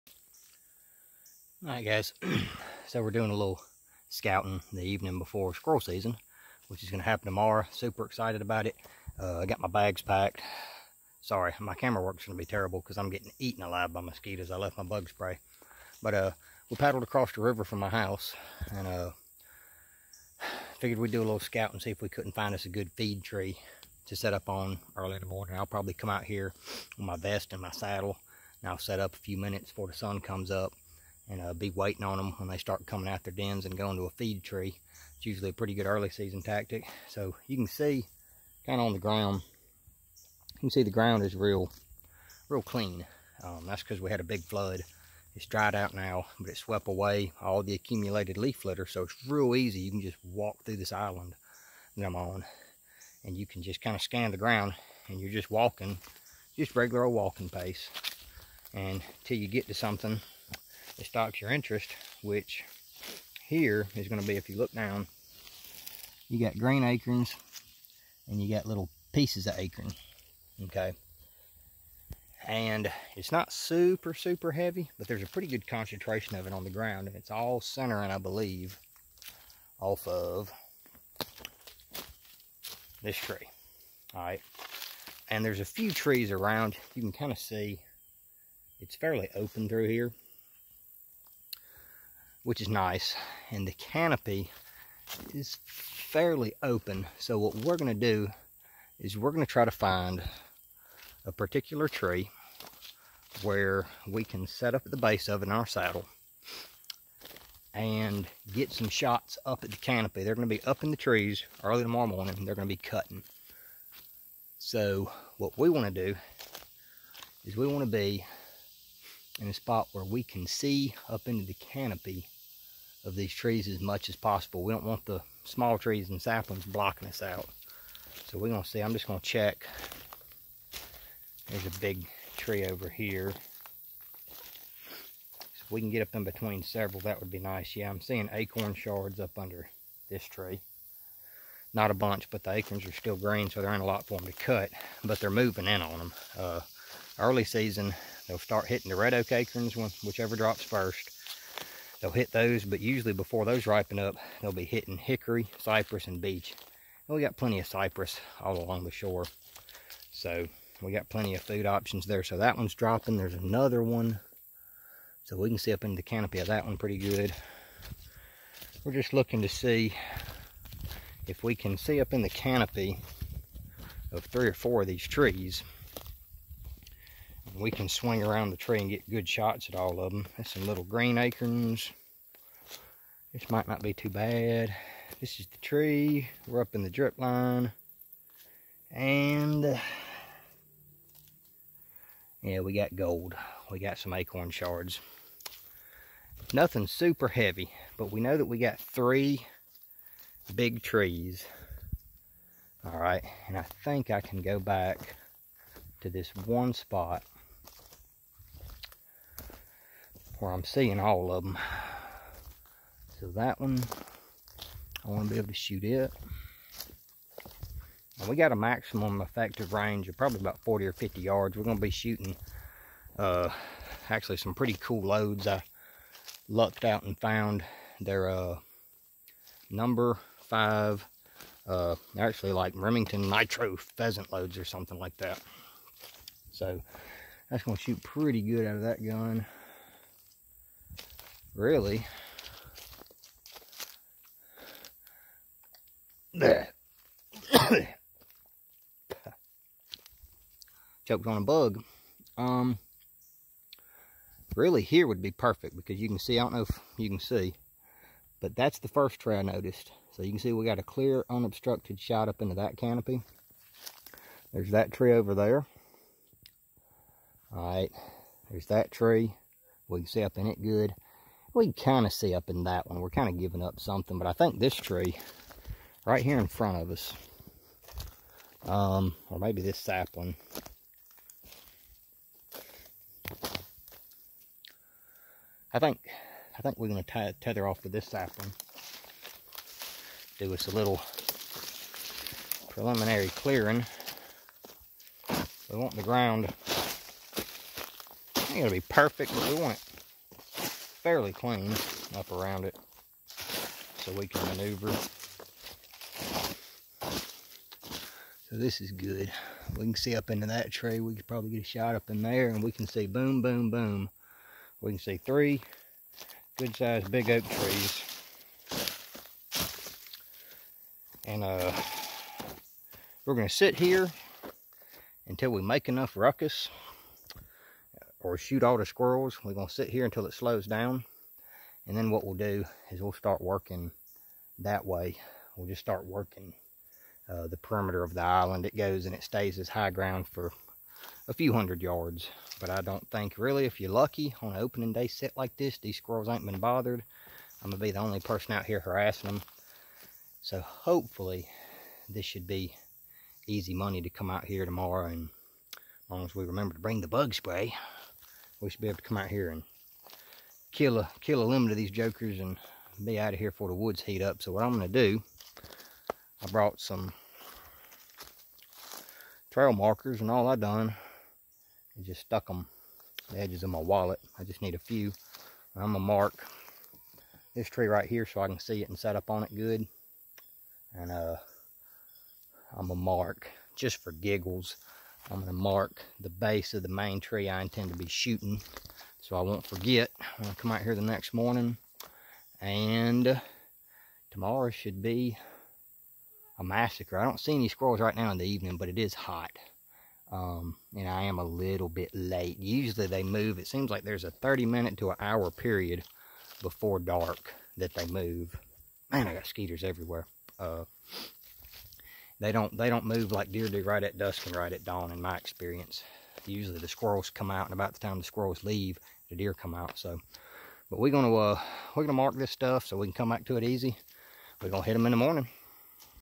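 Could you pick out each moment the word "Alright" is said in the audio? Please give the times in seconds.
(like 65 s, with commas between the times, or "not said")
1 s.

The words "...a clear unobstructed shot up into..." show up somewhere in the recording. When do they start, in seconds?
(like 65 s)
260 s.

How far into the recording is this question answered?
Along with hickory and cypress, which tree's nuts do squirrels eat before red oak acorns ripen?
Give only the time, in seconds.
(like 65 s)
156 s.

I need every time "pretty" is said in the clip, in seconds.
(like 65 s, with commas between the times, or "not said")
35 s, 75 s, 166 s, 224 s, 238 s.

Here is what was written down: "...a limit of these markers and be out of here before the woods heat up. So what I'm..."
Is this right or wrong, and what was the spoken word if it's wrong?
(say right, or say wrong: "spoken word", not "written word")
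wrong: "jokers", not "markers".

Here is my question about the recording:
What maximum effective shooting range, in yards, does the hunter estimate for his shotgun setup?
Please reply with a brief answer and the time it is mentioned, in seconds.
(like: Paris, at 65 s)
40 or 50 yards, at 220 s.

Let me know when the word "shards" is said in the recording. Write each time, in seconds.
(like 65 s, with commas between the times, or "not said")
138 s, 194 s.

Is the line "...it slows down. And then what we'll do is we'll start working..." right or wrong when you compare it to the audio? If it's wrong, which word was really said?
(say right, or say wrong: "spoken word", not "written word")
right.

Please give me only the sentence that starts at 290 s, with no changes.
Do us a little preliminary clearing.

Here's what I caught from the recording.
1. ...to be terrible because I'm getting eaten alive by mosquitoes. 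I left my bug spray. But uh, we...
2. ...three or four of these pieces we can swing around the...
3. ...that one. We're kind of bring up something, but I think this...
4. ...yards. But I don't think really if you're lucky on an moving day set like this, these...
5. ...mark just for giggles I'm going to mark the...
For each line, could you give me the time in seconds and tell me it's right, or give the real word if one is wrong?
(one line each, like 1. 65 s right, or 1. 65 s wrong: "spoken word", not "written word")
1. 12 s right
2. 174 s wrong: "trees", not "pieces"
3. 272 s wrong: "giving", not "bring"
4. 341 s wrong: "opening", not "moving"
5. 382 s right.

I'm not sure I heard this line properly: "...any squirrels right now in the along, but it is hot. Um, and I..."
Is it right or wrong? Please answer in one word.
wrong.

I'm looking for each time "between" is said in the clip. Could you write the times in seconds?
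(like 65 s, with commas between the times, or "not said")
136 s.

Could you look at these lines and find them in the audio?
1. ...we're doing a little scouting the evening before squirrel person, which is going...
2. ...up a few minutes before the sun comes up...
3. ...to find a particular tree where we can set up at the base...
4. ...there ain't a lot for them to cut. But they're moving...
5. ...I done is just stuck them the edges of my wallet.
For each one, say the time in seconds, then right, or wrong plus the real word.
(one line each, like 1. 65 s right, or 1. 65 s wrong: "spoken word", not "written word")
1. 3 s wrong: "season", not "person"
2. 28 s right
3. 99 s right
4. 143 s right
5. 370 s right.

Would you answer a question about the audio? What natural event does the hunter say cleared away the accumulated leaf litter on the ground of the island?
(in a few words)
A big flood.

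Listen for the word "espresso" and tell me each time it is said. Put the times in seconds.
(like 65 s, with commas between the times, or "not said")
not said.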